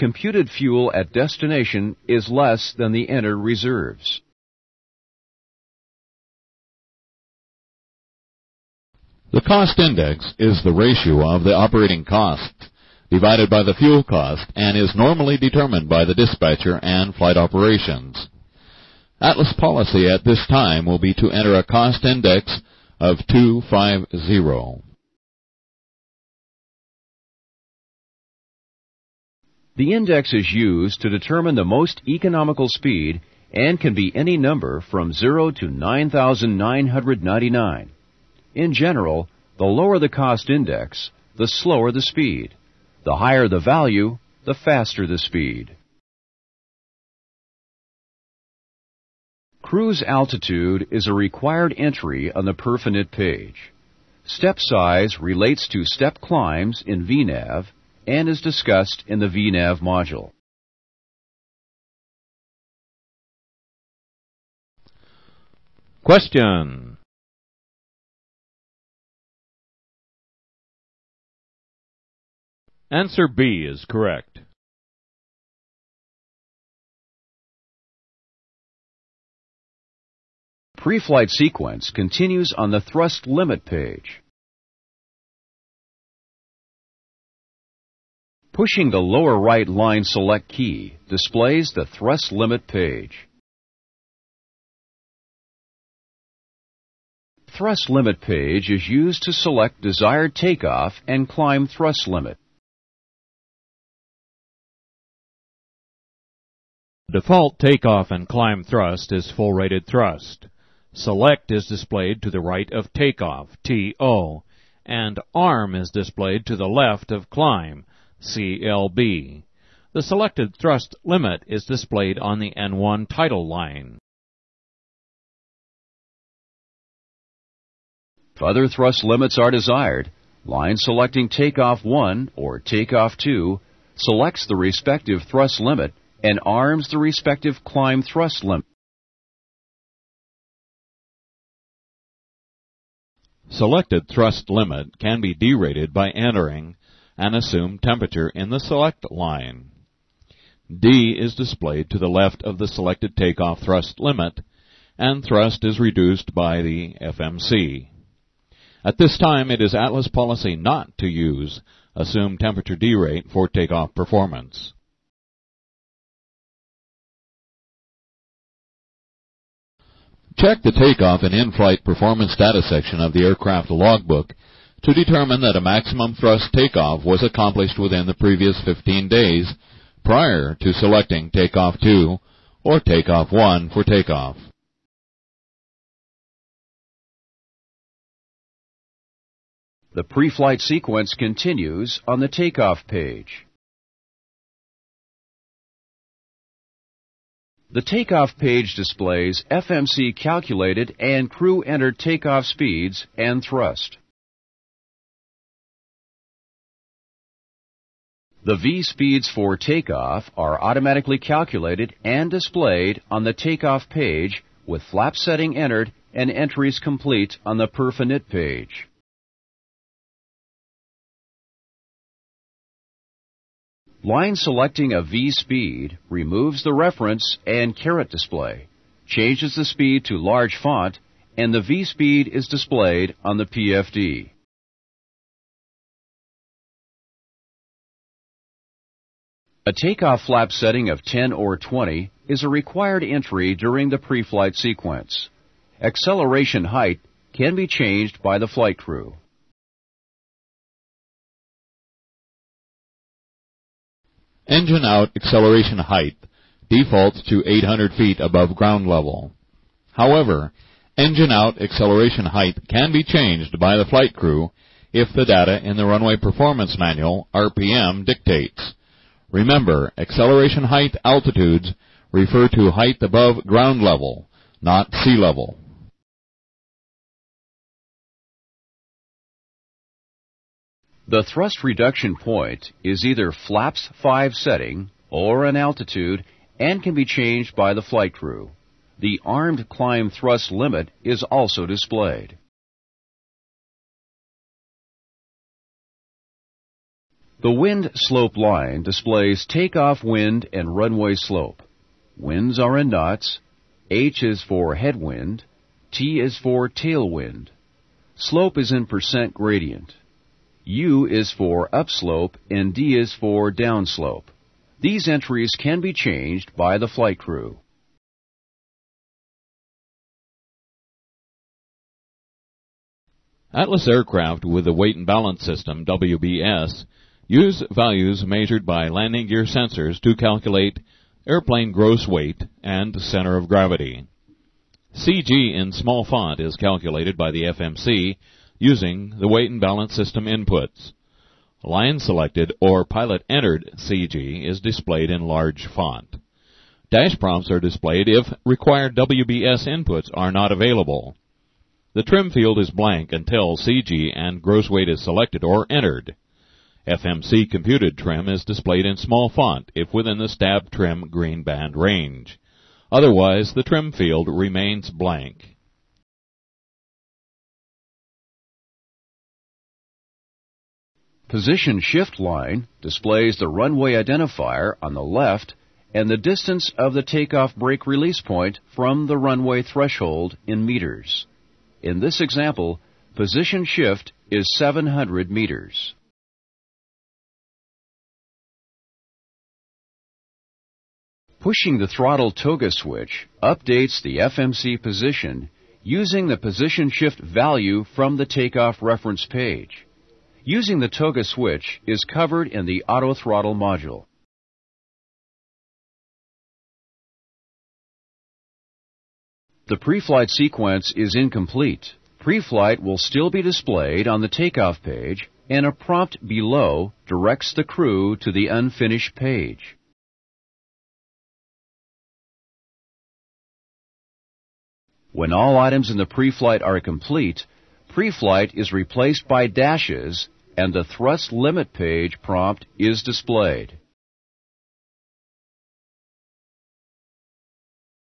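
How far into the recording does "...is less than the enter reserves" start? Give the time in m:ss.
0:02.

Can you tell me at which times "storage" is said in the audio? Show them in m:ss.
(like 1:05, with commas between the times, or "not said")
not said.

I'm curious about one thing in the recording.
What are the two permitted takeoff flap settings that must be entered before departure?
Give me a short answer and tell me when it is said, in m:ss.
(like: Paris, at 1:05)
10 or 20, at 4:01.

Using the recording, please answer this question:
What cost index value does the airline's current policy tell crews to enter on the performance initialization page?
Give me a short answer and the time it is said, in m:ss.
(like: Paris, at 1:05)
250, at 0:23.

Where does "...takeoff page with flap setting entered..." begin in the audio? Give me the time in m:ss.
3:33.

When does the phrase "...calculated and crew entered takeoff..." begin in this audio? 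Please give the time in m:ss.
3:20.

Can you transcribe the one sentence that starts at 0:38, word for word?
In general, the lower the cost index, the slower the speed.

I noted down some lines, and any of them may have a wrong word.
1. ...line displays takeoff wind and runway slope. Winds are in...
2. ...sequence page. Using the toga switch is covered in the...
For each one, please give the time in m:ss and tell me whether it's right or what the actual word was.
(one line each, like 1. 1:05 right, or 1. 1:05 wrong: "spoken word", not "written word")
1. 4:58 right
2. 6:38 wrong: "reference", not "sequence".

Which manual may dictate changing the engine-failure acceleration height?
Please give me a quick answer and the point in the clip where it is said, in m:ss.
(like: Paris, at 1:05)
Runway performance manual, at 4:25.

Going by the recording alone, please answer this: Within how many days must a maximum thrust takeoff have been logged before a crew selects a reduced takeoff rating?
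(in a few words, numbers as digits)
15 days.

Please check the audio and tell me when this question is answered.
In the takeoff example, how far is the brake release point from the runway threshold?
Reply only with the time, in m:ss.
6:24.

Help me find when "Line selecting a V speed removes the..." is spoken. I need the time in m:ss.
3:44.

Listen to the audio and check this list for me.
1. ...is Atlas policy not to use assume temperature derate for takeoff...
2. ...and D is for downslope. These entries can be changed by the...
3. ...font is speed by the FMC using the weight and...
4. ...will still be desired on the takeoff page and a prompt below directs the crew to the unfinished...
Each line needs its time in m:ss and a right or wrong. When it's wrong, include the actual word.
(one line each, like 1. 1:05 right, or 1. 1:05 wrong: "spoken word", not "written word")
1. 2:39 right
2. 5:12 right
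3. 5:36 wrong: "calculated", not "speed"
4. 6:52 wrong: "displayed", not "desired".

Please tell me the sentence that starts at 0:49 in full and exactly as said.
Cruise altitude is a required entry on the Perfinit page.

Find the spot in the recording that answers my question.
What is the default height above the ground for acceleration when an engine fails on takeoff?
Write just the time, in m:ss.
4:17.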